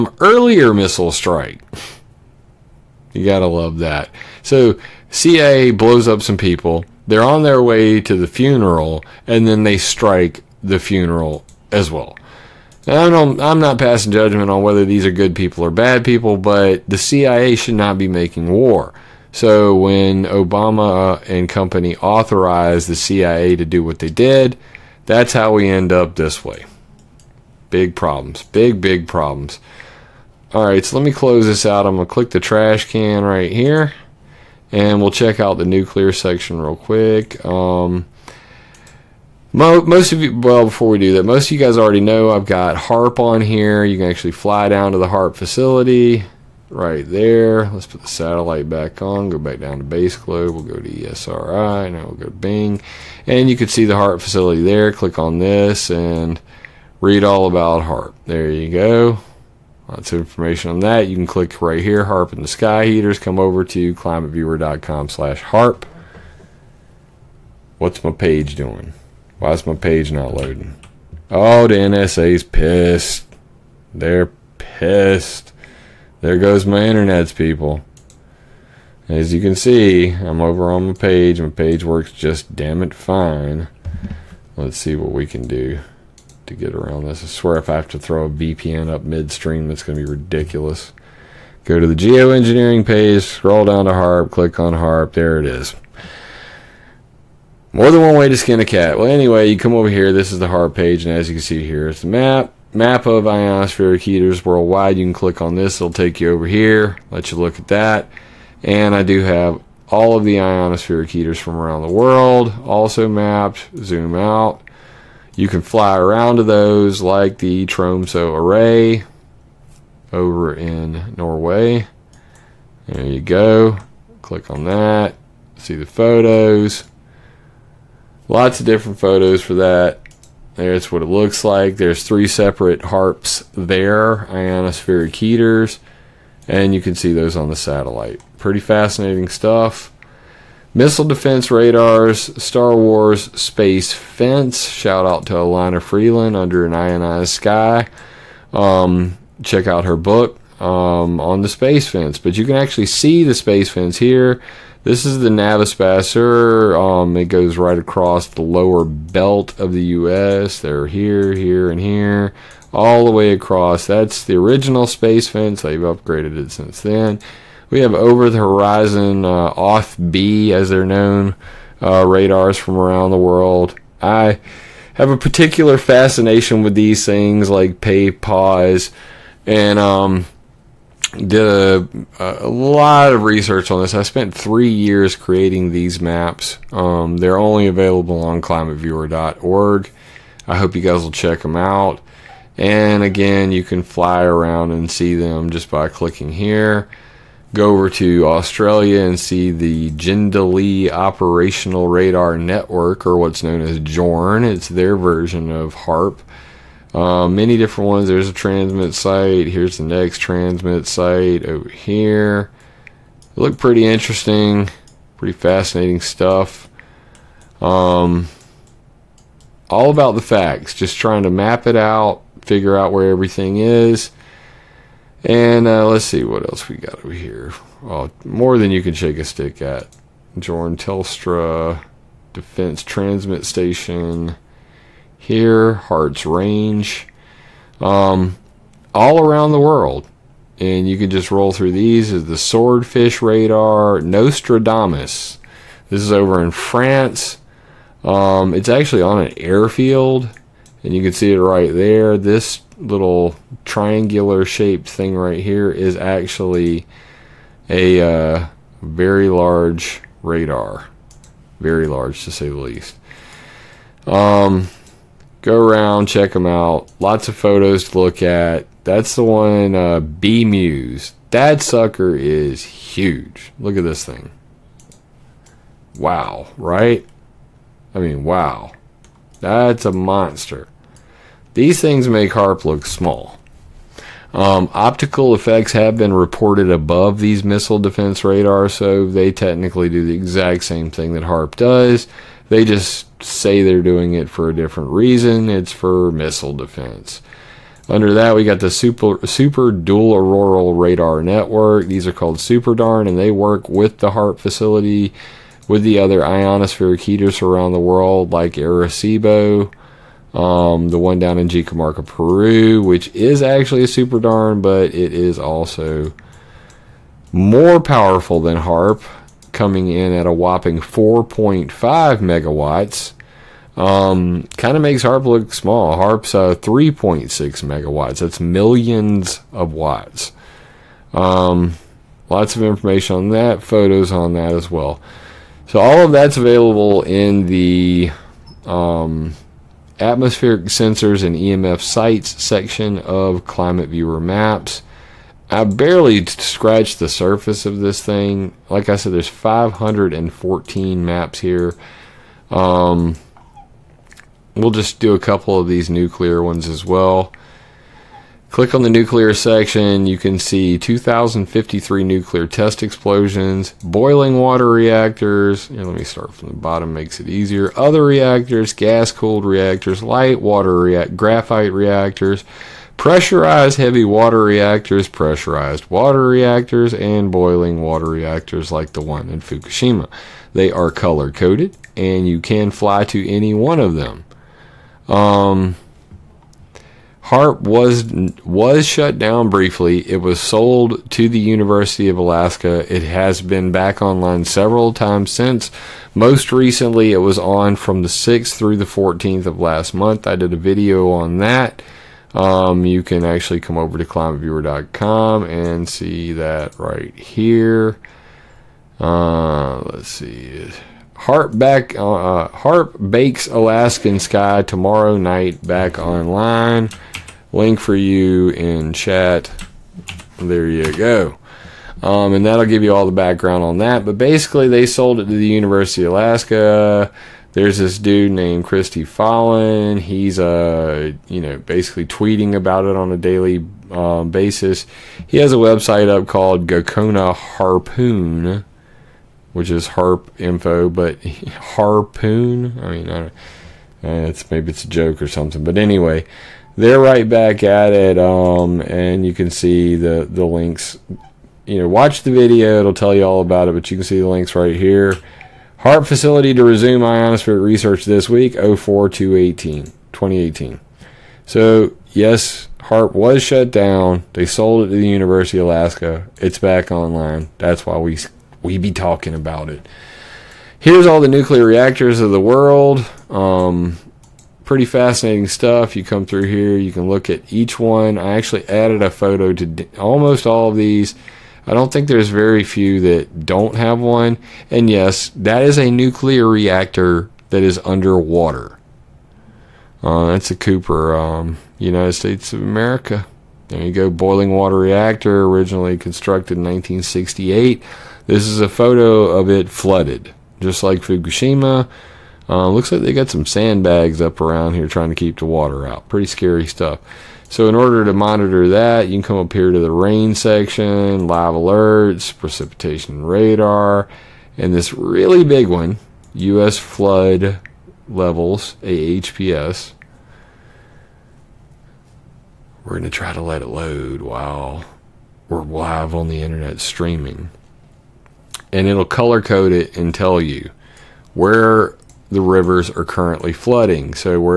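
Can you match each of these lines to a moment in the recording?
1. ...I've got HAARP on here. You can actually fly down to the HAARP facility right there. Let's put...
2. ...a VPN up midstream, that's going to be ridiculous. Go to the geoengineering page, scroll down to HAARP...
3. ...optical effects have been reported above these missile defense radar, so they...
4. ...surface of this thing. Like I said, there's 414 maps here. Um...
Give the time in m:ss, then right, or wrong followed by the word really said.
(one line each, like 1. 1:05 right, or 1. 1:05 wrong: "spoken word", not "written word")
1. 0:42 right
2. 1:28 right
3. 4:44 right
4. 5:47 wrong: "514", not "414".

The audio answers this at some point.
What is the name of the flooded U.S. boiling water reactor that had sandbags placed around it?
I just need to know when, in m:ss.
8:10.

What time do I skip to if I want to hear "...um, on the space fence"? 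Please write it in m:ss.
2:30.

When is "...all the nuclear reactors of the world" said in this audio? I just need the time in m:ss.
7:51.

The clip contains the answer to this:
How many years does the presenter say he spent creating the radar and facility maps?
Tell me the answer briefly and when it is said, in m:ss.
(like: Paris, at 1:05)
3 years, at 3:04.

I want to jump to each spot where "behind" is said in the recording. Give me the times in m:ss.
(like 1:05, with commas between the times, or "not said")
not said.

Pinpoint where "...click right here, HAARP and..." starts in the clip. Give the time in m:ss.
1:01.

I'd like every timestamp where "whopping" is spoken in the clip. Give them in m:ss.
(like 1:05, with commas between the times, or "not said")
5:20.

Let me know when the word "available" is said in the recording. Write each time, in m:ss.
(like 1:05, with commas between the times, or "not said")
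3:07, 5:36.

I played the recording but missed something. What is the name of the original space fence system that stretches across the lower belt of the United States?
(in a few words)
NAVSPASUR.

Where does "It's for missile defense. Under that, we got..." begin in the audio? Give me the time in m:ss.
4:55.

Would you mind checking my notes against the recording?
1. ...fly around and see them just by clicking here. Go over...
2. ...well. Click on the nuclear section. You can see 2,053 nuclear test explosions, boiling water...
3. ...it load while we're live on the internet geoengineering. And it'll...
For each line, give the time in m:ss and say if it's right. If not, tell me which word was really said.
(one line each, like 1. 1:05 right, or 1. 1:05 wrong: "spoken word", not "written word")
1. 3:13 right
2. 5:56 right
3. 8:43 wrong: "streaming", not "geoengineering".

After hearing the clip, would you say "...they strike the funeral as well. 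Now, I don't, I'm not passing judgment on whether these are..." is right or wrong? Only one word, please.
right.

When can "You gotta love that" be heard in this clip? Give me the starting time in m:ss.
0:03.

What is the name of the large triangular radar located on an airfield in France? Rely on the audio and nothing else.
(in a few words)
Nostradamus.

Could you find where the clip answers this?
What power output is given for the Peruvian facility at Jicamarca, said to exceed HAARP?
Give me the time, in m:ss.
5:20.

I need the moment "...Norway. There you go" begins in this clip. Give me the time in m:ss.
2:01.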